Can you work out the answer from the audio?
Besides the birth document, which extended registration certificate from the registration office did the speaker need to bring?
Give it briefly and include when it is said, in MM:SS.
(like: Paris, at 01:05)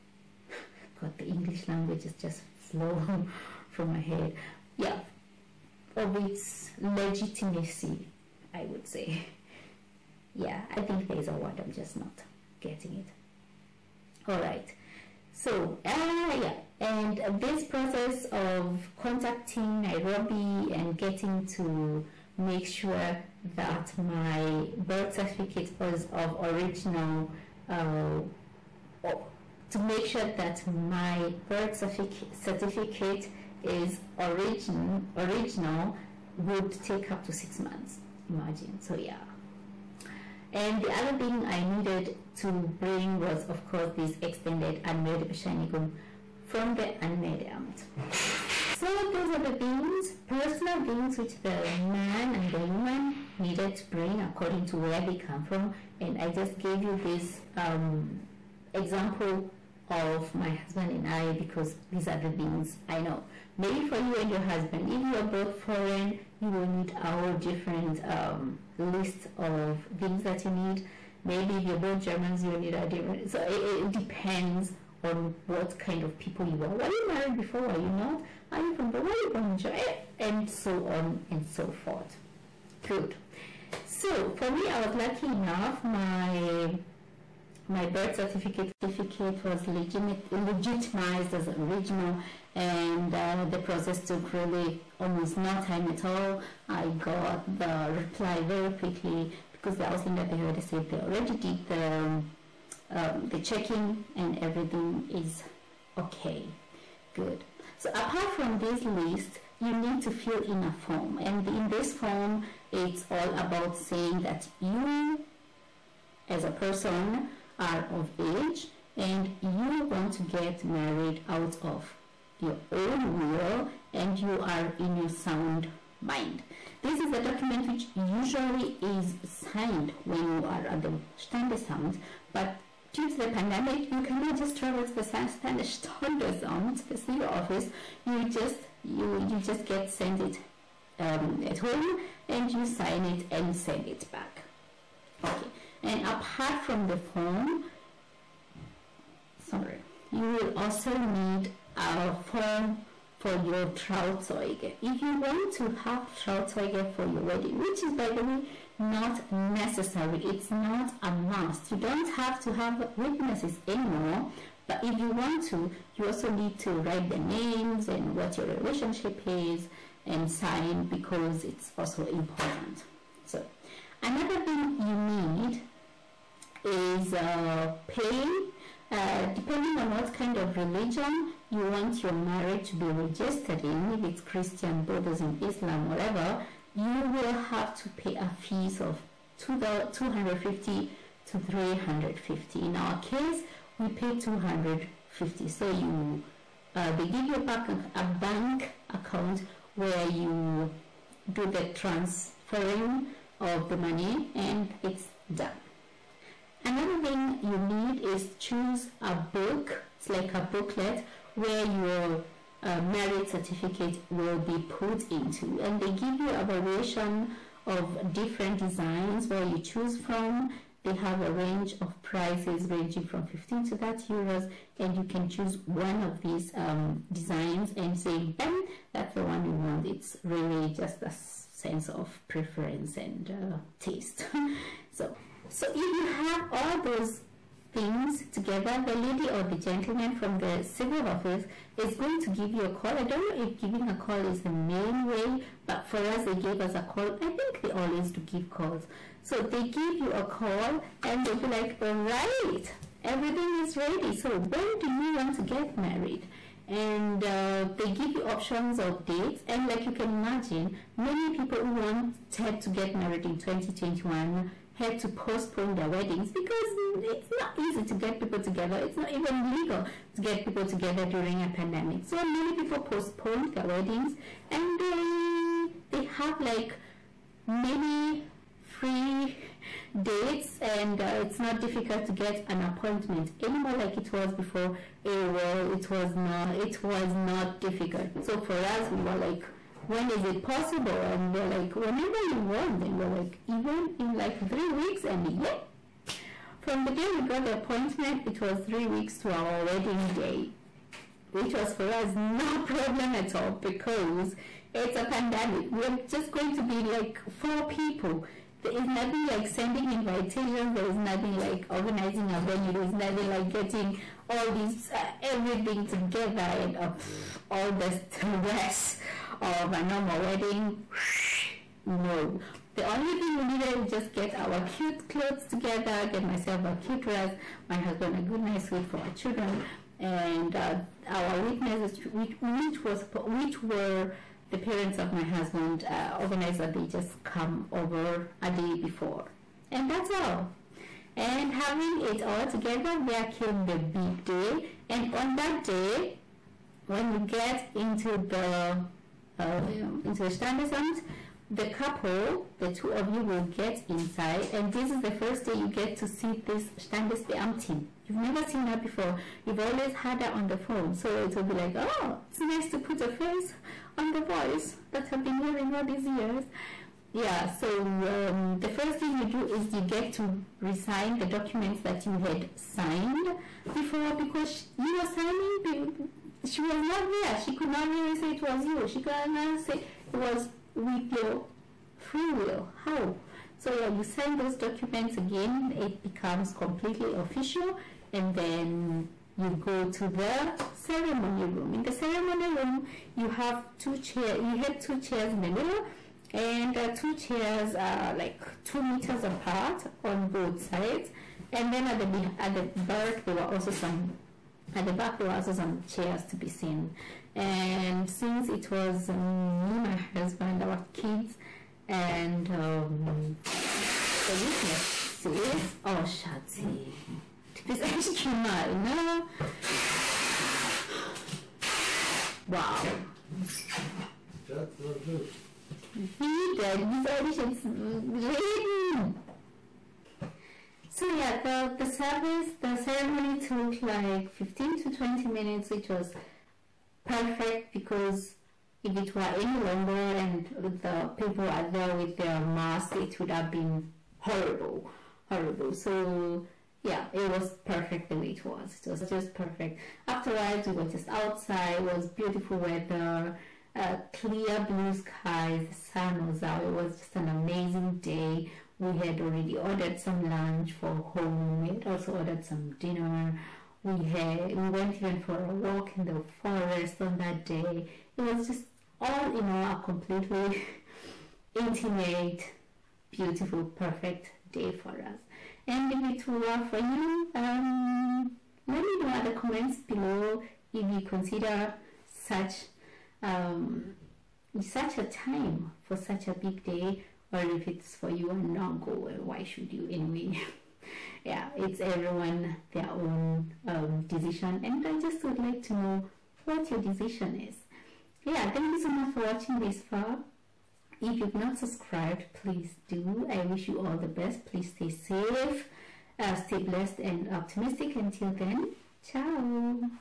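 Anmeldebescheinigung, at 00:44.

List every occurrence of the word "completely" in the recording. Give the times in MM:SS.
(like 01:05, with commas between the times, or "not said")
06:26, 07:49.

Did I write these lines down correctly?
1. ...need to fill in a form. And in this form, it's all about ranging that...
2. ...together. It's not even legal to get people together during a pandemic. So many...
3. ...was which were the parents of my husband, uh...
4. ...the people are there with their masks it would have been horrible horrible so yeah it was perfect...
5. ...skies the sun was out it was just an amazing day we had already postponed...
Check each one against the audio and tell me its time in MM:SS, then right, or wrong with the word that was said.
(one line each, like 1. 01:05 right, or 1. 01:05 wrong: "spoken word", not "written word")
1. 01:49 wrong: "saying", not "ranging"
2. 04:28 right
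3. 05:32 right
4. 07:20 right
5. 07:34 wrong: "ordered", not "postponed".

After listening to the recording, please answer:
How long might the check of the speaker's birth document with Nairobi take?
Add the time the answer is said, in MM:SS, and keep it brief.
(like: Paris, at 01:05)
6 months, at 00:37.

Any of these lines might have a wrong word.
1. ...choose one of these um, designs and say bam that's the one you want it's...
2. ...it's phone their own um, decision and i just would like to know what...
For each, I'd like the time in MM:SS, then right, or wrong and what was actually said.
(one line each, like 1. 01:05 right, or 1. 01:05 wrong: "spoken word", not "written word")
1. 03:45 right
2. 08:11 wrong: "everyone", not "phone".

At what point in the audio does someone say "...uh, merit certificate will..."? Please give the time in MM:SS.
03:32.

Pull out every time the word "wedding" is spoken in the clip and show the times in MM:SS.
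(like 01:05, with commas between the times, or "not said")
02:37, 04:25, 04:33, 04:59, 05:20.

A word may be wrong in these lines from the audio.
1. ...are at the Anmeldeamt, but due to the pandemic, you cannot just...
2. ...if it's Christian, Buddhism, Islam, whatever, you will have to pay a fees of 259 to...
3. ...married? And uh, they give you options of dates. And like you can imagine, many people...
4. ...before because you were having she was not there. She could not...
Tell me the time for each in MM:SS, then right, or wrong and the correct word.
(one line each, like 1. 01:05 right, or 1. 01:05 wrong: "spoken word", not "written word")
1. 02:10 wrong: "Standesamt", not "Anmeldeamt"
2. 03:03 wrong: "250", not "259"
3. 04:15 right
4. 06:13 wrong: "signing", not "having".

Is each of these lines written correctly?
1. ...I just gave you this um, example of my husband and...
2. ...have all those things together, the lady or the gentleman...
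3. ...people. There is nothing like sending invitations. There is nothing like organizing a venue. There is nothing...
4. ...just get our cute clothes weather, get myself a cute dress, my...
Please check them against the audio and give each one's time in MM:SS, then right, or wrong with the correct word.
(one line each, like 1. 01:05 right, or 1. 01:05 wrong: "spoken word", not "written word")
1. 00:56 right
2. 03:56 right
3. 05:07 right
4. 05:23 wrong: "together", not "weather".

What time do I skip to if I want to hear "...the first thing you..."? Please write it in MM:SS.
06:08.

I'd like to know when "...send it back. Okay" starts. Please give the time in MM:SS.
02:23.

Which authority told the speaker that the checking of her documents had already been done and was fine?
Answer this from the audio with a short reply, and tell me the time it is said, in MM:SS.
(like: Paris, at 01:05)
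Ausländer Behörde, at 01:39.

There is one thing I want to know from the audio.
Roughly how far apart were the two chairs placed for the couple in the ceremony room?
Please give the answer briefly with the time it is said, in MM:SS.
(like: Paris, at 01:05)
2 meters, at 06:38.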